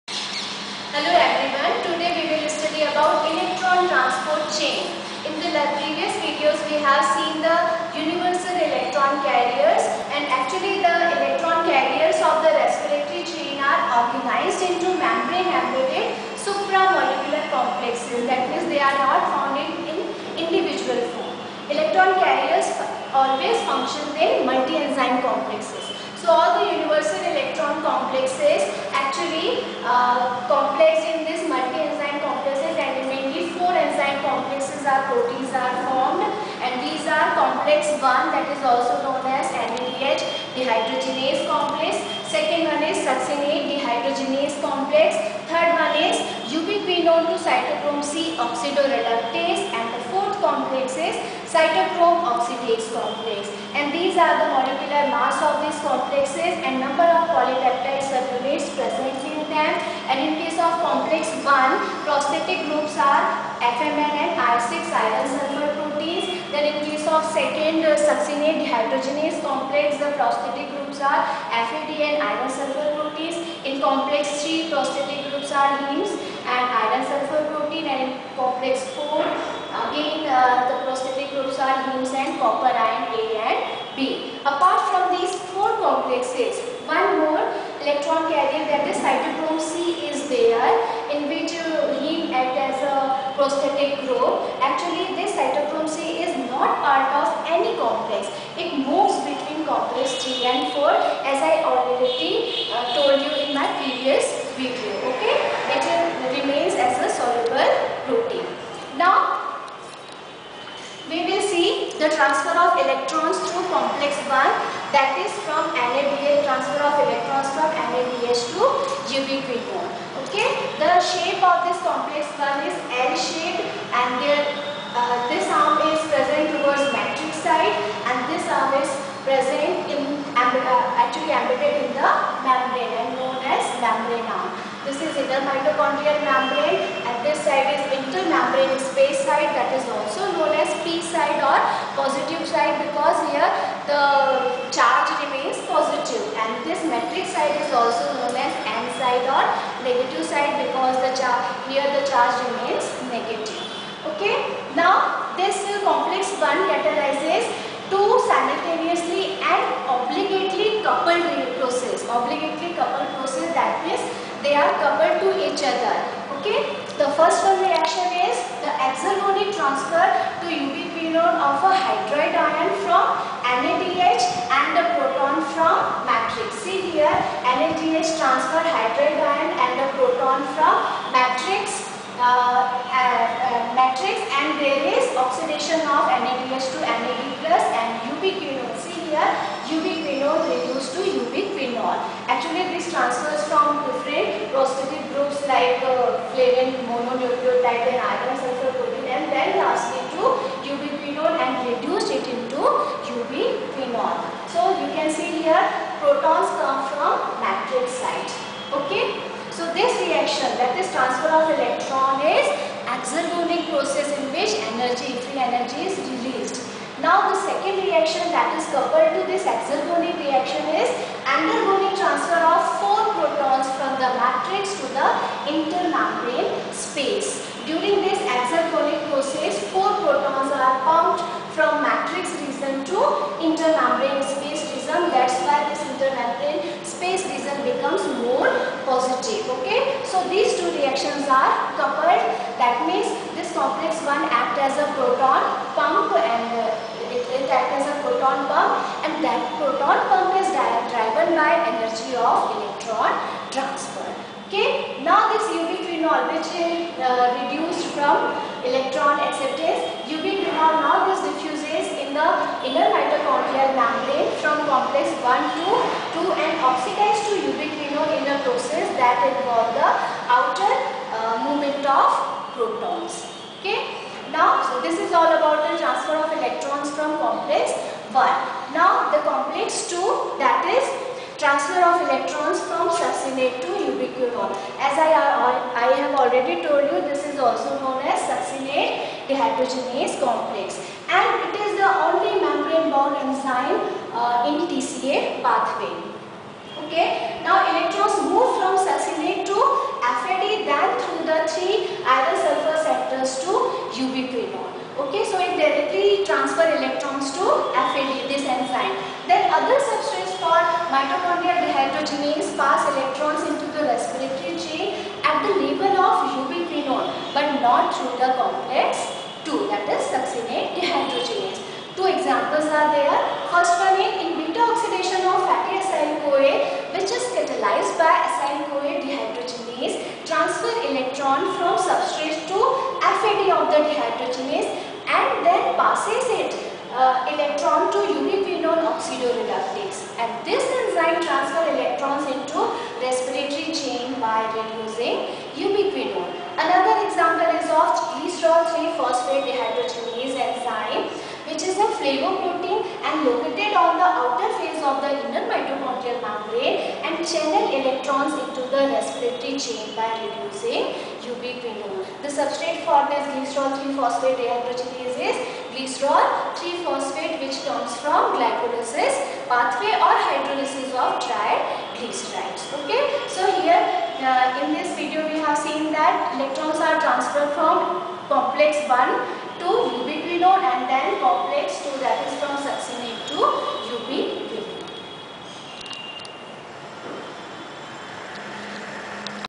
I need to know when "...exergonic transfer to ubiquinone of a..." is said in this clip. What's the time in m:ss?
2:48.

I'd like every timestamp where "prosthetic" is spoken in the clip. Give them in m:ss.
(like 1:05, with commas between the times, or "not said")
1:02, 1:10, 1:14, 1:20, 1:33, 3:14.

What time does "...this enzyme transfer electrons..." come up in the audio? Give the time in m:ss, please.
5:40.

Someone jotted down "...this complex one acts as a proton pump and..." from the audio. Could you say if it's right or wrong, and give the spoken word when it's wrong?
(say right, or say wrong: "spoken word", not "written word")
right.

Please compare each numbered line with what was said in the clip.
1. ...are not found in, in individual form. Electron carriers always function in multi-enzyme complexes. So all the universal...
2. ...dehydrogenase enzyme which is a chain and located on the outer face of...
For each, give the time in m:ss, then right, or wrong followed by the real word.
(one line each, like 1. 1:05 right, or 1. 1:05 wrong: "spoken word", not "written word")
1. 0:18 right
2. 5:49 wrong: "flavoprotein", not "chain".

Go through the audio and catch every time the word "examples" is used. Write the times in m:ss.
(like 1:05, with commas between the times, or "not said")
5:22, 5:47.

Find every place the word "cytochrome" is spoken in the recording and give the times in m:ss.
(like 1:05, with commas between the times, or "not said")
0:47, 0:51, 1:28, 1:35.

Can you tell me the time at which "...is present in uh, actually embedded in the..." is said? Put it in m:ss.
2:08.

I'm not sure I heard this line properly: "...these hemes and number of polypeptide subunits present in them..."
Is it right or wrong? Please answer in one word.
wrong.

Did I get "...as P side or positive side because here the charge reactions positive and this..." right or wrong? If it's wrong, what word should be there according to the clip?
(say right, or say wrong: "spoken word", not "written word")
wrong: "remains", not "reactions".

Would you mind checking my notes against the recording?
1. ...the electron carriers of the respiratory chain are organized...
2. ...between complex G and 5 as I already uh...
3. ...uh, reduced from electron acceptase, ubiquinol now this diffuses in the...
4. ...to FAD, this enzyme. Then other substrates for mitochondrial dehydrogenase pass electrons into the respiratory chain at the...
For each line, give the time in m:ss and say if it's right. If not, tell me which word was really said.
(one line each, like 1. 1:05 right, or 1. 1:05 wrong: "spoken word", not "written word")
1. 0:10 right
2. 1:39 wrong: "4", not "5"
3. 4:16 right
4. 5:07 right.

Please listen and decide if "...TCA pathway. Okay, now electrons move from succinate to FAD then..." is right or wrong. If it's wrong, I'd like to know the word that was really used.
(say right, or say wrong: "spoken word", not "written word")
right.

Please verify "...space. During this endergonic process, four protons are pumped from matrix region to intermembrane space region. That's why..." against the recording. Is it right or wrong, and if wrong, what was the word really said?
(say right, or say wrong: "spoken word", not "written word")
wrong: "exergonic", not "endergonic".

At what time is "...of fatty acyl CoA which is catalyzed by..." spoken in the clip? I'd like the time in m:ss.
5:25.